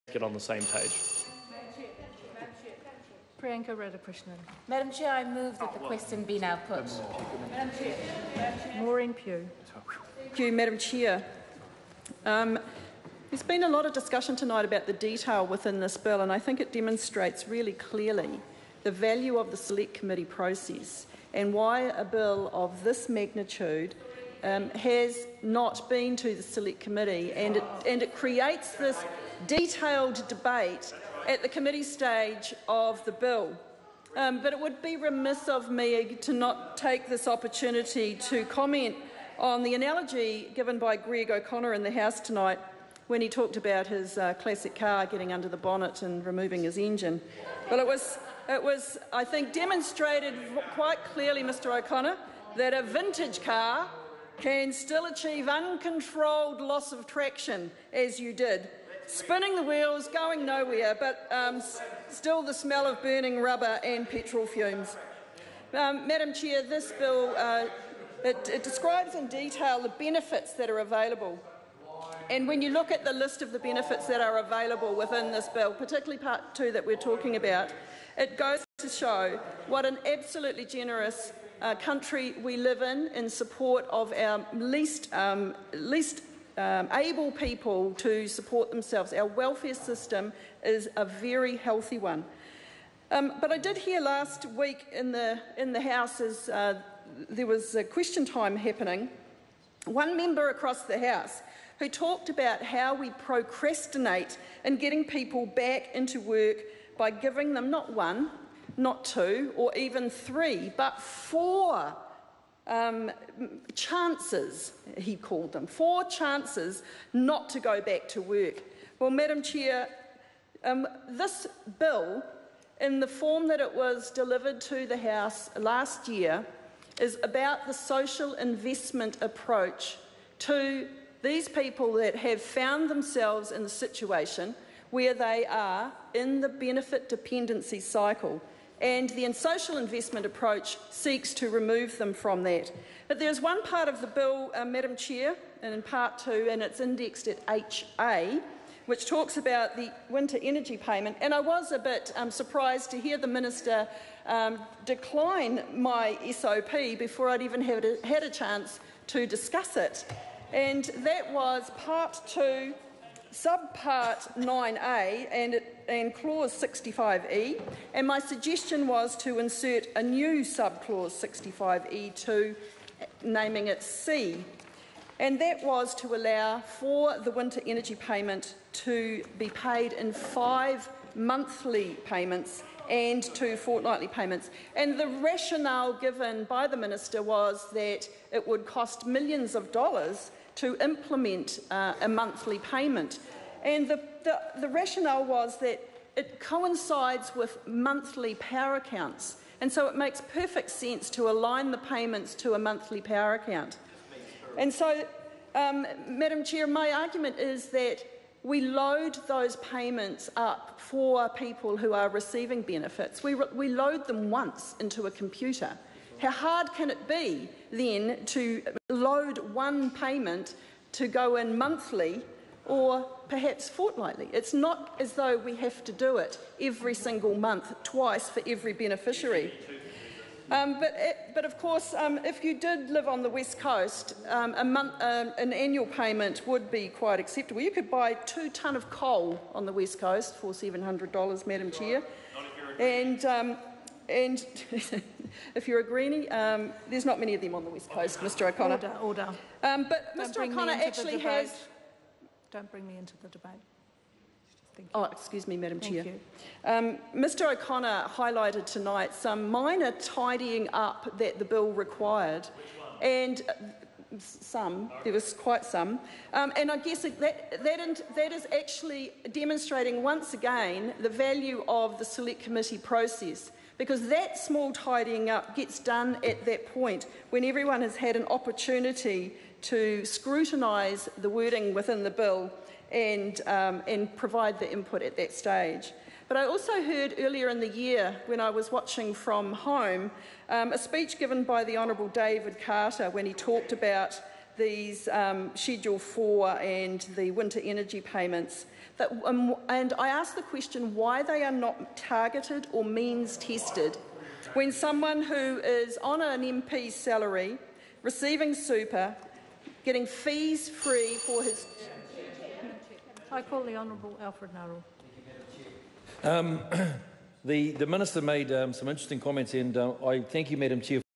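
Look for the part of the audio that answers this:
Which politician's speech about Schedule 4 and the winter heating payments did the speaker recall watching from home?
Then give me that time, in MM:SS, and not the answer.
04:52.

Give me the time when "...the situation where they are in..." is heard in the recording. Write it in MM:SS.
02:13.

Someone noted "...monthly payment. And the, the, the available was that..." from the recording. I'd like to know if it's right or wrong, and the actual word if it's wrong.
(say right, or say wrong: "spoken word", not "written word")
wrong: "rationale", not "available".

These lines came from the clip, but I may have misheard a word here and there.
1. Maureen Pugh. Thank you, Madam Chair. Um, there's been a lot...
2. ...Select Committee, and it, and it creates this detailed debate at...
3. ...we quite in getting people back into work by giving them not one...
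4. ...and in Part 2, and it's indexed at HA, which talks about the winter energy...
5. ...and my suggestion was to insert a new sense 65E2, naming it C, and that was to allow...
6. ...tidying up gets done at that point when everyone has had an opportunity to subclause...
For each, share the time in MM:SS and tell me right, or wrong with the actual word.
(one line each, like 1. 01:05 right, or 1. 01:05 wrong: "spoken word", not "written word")
1. 00:08 right
2. 00:26 right
3. 01:42 wrong: "procrastinate", not "quite"
4. 02:25 right
5. 02:47 wrong: "subclause", not "sense"
6. 04:34 wrong: "scrutinise", not "subclause".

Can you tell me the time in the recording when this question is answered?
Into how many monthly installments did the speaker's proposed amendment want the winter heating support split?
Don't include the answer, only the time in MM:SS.
03:00.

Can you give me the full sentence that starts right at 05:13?
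I call the Honourable Alfred Narrell.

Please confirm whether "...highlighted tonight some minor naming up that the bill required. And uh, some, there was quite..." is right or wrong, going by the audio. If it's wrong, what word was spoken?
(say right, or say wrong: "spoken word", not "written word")
wrong: "tidying", not "naming".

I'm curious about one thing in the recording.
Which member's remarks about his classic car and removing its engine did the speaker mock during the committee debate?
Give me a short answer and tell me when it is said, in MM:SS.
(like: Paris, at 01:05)
Greg O'Connor, at 00:40.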